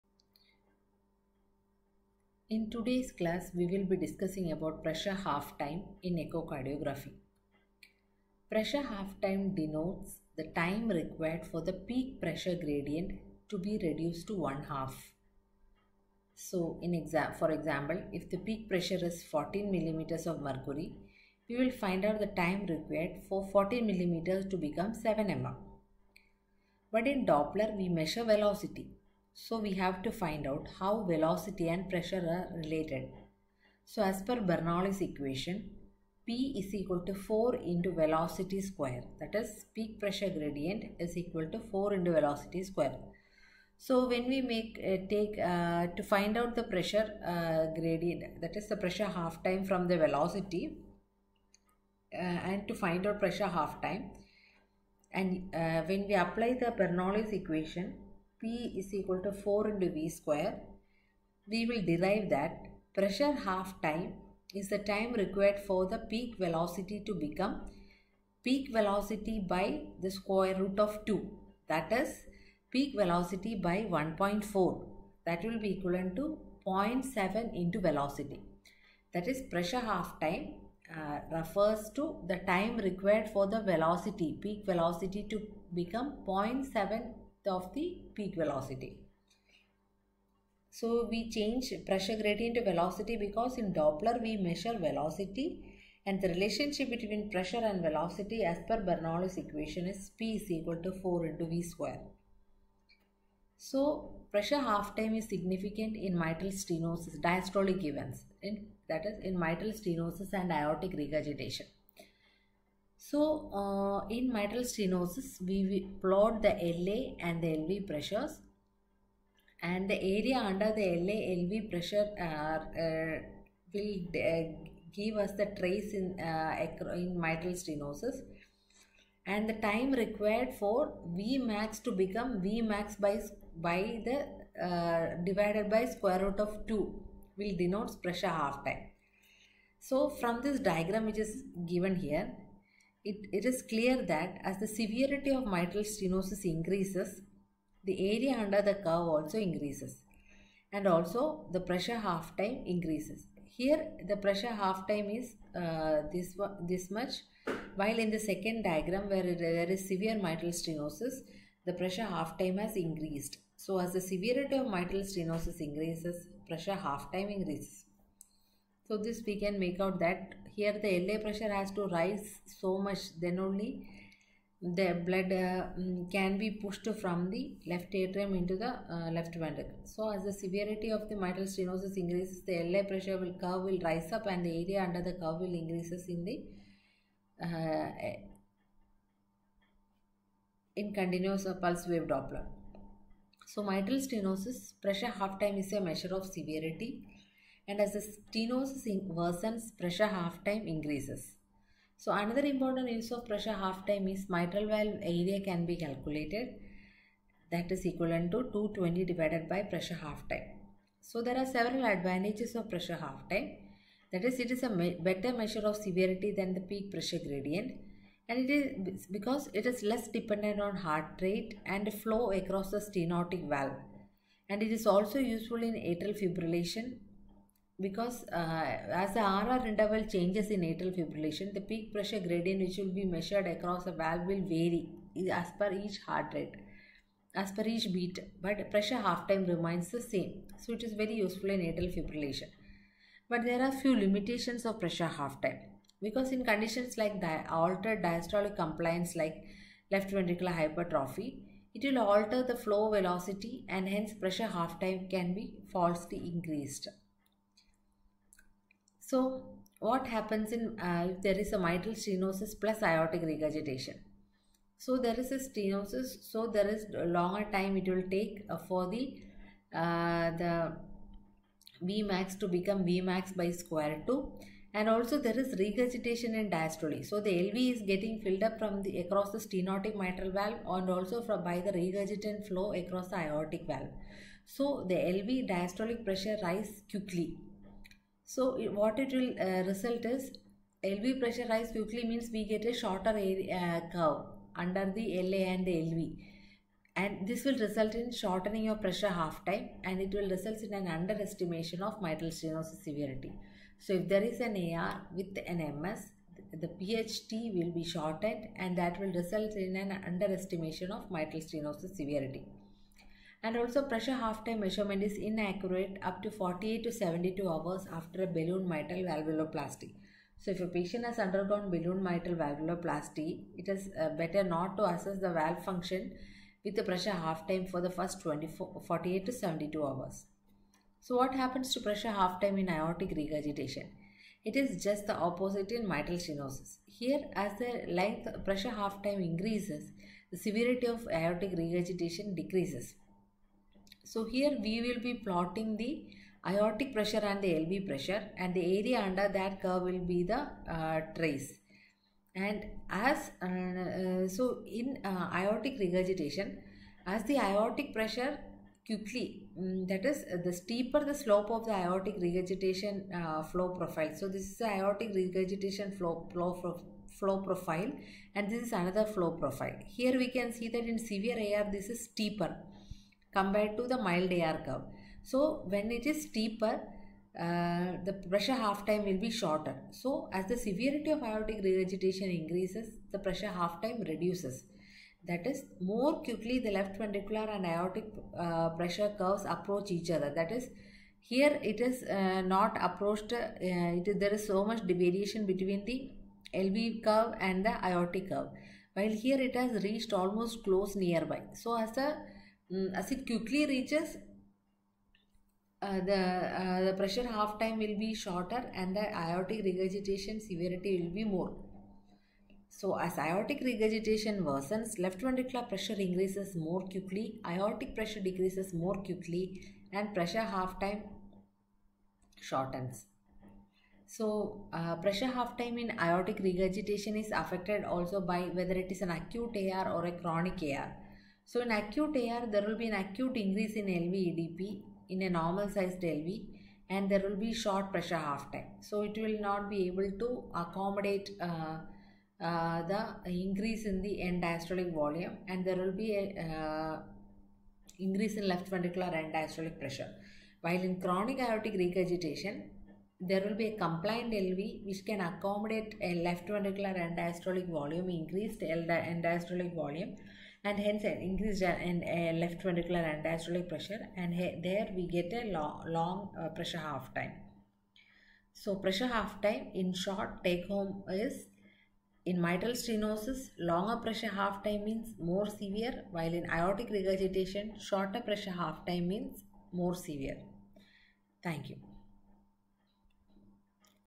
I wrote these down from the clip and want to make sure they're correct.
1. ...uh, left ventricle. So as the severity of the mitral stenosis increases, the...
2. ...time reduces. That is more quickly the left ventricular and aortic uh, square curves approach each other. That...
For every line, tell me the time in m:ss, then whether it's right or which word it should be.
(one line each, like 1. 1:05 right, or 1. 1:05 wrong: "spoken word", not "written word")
1. 2:58 right
2. 6:23 wrong: "pressure", not "square".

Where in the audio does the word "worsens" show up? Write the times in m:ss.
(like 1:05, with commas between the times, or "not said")
3:19, 6:54.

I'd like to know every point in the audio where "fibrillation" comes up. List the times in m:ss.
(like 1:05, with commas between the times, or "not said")
3:46, 3:50, 4:01.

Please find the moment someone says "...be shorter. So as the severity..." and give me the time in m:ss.
6:19.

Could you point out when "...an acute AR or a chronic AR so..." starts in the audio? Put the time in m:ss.
7:09.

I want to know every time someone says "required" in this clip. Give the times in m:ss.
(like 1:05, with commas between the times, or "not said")
0:10, 0:22, 1:05, 1:22, 2:09.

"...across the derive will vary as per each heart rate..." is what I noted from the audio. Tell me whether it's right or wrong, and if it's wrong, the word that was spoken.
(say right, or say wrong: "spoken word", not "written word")
wrong: "valve", not "derive".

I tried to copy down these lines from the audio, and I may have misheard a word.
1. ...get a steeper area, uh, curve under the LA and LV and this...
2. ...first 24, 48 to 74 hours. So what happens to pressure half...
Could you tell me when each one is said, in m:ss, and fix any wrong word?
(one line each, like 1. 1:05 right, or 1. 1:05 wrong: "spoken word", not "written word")
1. 4:52 wrong: "shorter", not "steeper"
2. 5:27 wrong: "72", not "74".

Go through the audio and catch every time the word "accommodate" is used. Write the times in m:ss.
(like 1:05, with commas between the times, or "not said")
7:20, 7:35.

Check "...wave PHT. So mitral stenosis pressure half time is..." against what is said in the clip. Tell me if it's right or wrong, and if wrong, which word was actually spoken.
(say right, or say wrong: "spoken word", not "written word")
wrong: "Doppler", not "PHT".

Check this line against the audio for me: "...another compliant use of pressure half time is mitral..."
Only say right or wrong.
wrong.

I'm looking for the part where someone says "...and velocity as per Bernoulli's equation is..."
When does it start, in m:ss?
1:37.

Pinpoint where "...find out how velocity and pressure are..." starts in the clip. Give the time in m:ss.
0:30.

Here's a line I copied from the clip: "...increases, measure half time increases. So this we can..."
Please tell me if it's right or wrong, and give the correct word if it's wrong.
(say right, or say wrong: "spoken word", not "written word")
wrong: "pressure", not "measure".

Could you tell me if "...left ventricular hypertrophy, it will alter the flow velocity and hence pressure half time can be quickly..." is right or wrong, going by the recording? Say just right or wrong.
wrong.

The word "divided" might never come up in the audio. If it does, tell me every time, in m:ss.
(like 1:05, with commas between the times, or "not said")
2:15, 3:29.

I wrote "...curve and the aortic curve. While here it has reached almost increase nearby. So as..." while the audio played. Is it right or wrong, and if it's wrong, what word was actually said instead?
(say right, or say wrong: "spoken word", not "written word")
wrong: "close", not "increase".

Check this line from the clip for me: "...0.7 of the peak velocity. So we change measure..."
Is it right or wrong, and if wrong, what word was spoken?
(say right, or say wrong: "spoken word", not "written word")
wrong: "pressure", not "measure".